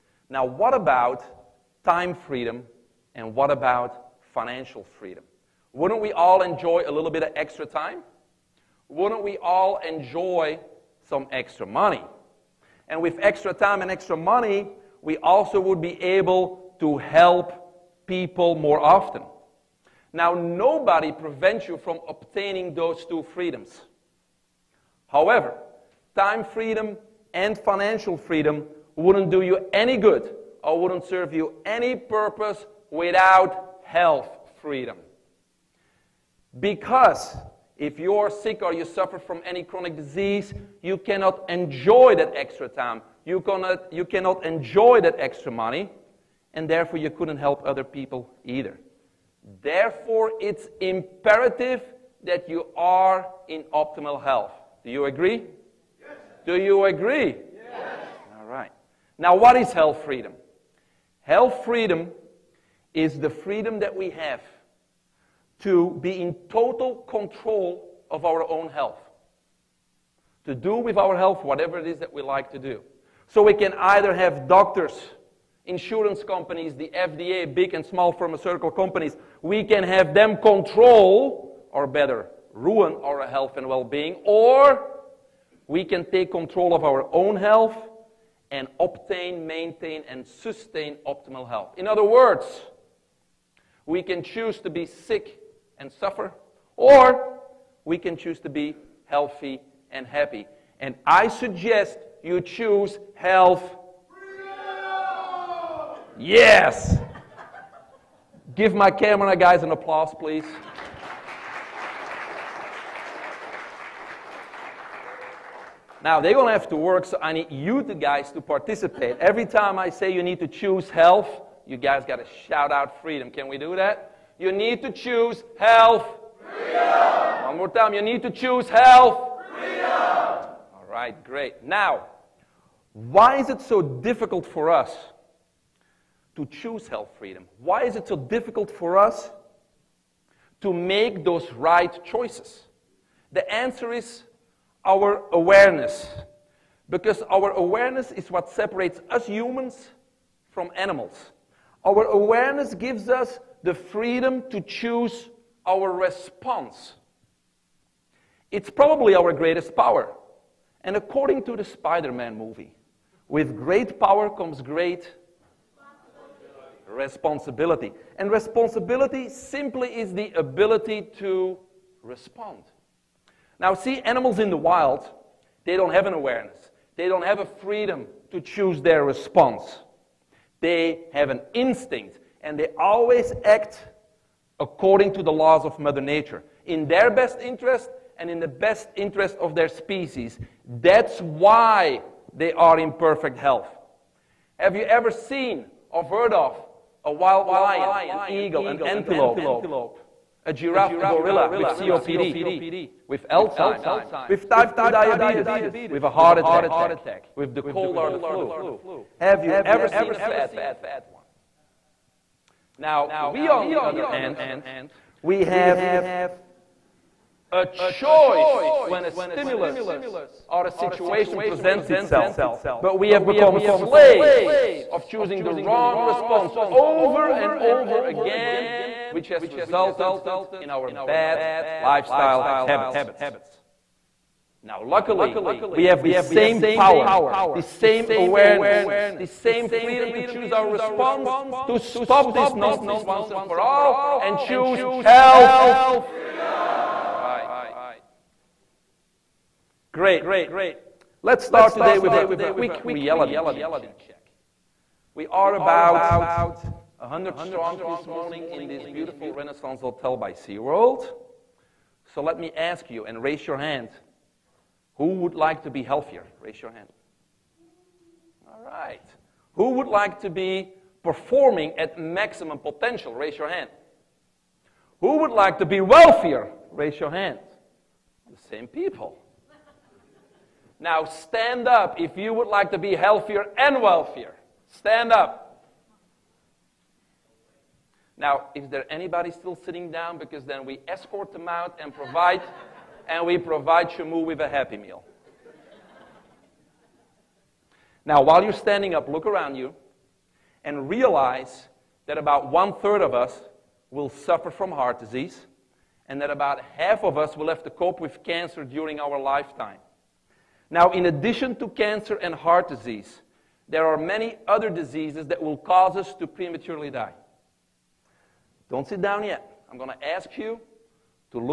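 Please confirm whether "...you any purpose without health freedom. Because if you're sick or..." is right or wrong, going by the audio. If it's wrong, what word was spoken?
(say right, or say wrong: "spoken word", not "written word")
right.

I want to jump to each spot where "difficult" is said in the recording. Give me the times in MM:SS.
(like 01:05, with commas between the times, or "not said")
02:13, 02:18.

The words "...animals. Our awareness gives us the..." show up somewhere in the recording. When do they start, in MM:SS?
02:30.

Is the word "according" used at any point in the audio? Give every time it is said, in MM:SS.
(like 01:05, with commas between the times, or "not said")
02:40, 03:04.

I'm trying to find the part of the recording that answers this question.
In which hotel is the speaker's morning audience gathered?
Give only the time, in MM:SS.
04:19.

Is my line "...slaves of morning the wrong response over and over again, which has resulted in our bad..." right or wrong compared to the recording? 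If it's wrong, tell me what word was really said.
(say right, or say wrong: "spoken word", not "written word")
wrong: "choosing", not "morning".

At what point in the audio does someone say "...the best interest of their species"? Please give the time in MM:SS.
03:08.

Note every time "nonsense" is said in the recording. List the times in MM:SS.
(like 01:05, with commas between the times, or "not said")
04:02.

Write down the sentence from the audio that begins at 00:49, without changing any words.
Therefore, it's imperative that you are in optimal health.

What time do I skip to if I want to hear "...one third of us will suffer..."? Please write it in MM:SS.
05:02.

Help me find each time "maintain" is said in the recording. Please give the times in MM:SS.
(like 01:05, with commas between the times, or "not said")
01:29.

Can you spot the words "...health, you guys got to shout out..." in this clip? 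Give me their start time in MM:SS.
02:00.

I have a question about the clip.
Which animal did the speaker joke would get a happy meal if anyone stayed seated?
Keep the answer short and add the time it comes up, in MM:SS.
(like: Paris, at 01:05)
Shamu, at 04:53.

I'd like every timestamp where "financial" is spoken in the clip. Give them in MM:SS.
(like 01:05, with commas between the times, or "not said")
00:04, 00:27.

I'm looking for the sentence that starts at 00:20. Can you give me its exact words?
Now, nobody prevents you from obtaining those two freedoms.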